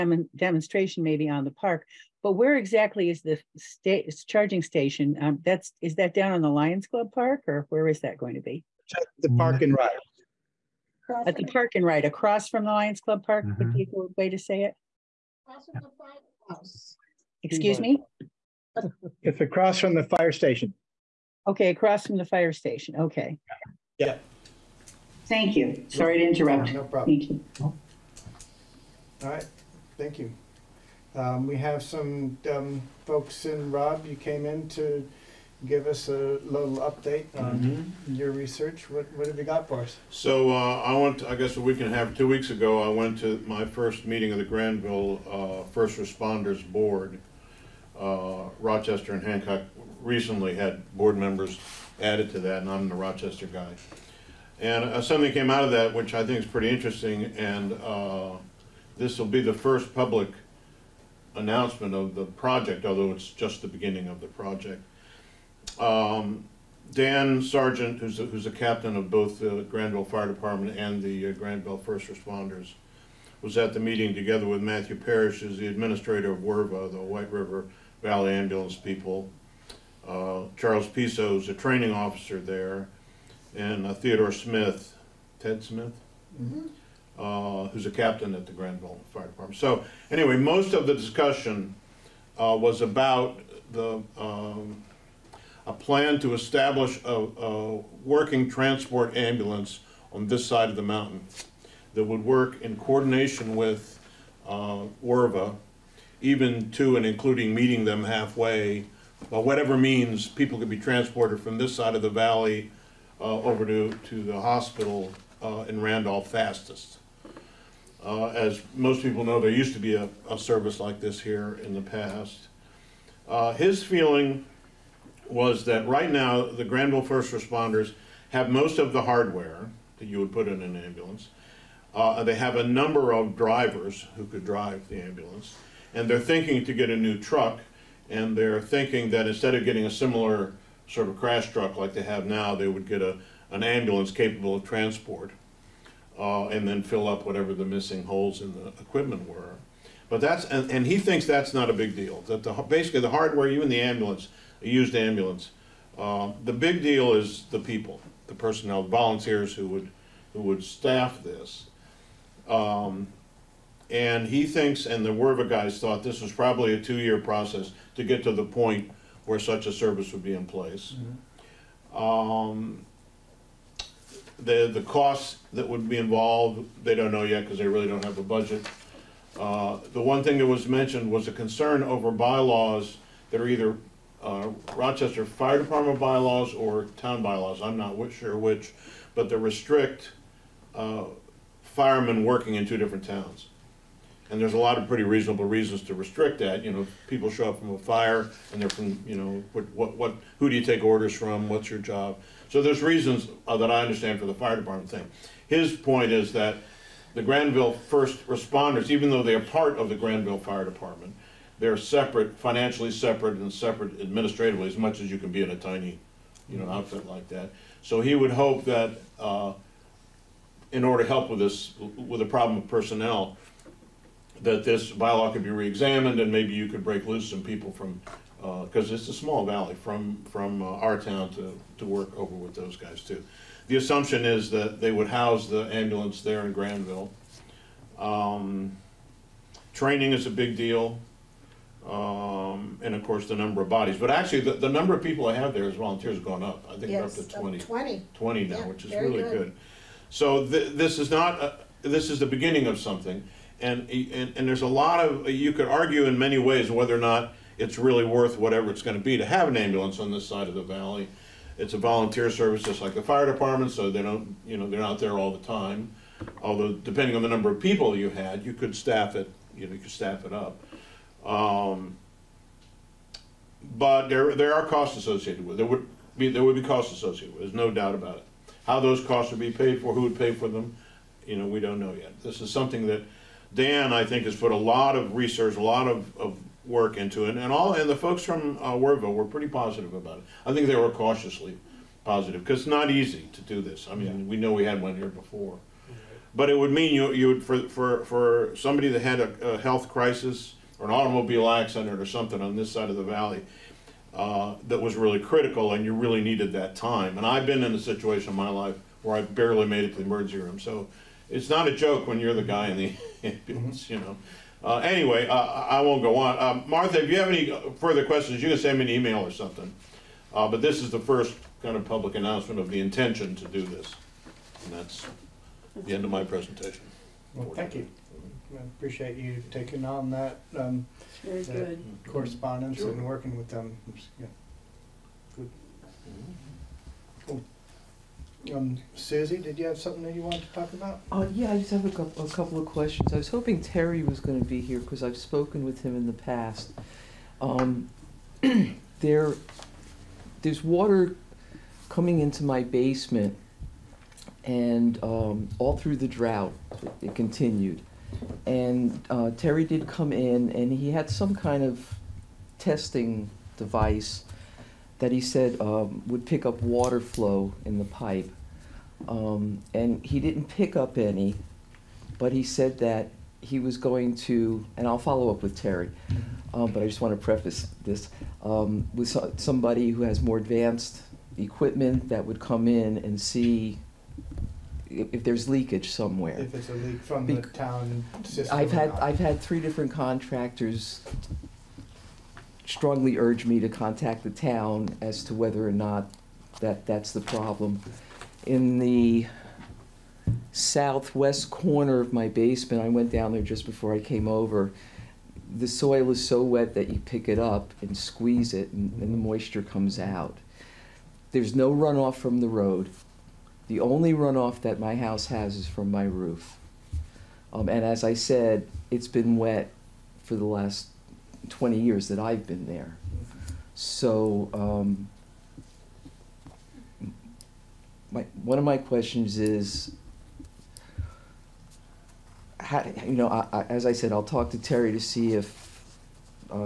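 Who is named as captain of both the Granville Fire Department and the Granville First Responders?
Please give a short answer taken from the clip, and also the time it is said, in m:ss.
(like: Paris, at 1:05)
Dan Sargent, at 1:06.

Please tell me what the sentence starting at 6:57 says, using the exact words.
Um, and as I said, it's been wet for the last 20 years that I've been there.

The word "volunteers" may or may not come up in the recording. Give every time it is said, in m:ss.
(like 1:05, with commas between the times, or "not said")
2:38, 4:05, 4:21.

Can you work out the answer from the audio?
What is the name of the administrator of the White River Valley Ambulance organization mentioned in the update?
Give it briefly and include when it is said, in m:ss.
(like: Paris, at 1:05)
Matthew Parrish, at 1:14.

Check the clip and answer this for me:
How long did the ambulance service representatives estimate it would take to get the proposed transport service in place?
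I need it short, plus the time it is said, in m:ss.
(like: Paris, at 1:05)
2 years, at 2:46.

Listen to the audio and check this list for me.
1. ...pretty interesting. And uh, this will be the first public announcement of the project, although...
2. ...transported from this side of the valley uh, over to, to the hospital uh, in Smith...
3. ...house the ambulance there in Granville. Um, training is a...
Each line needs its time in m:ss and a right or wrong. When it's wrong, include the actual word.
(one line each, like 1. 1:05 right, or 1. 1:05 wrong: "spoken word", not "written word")
1. 0:56 right
2. 1:50 wrong: "Randolph", not "Smith"
3. 3:55 right.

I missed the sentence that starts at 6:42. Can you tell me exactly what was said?
I went down there just before I came over.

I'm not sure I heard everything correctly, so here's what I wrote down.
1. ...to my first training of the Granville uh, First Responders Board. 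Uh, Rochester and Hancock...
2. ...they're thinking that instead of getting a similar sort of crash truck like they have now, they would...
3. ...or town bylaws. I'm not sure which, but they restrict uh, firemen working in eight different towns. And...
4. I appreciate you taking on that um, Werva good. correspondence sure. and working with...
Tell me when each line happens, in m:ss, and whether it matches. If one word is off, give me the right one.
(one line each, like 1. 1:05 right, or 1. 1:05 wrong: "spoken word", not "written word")
1. 0:43 wrong: "meeting", not "training"
2. 2:18 right
3. 3:06 wrong: "two", not "eight"
4. 5:28 wrong: "Very", not "Werva".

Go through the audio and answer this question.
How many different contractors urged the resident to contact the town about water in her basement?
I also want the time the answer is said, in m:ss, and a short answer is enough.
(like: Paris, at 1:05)
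3, at 6:29.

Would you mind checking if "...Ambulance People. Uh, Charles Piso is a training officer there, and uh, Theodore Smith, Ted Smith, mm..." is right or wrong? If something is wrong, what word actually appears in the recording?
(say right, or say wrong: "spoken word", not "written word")
right.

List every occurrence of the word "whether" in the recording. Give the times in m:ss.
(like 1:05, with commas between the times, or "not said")
4:16, 6:35.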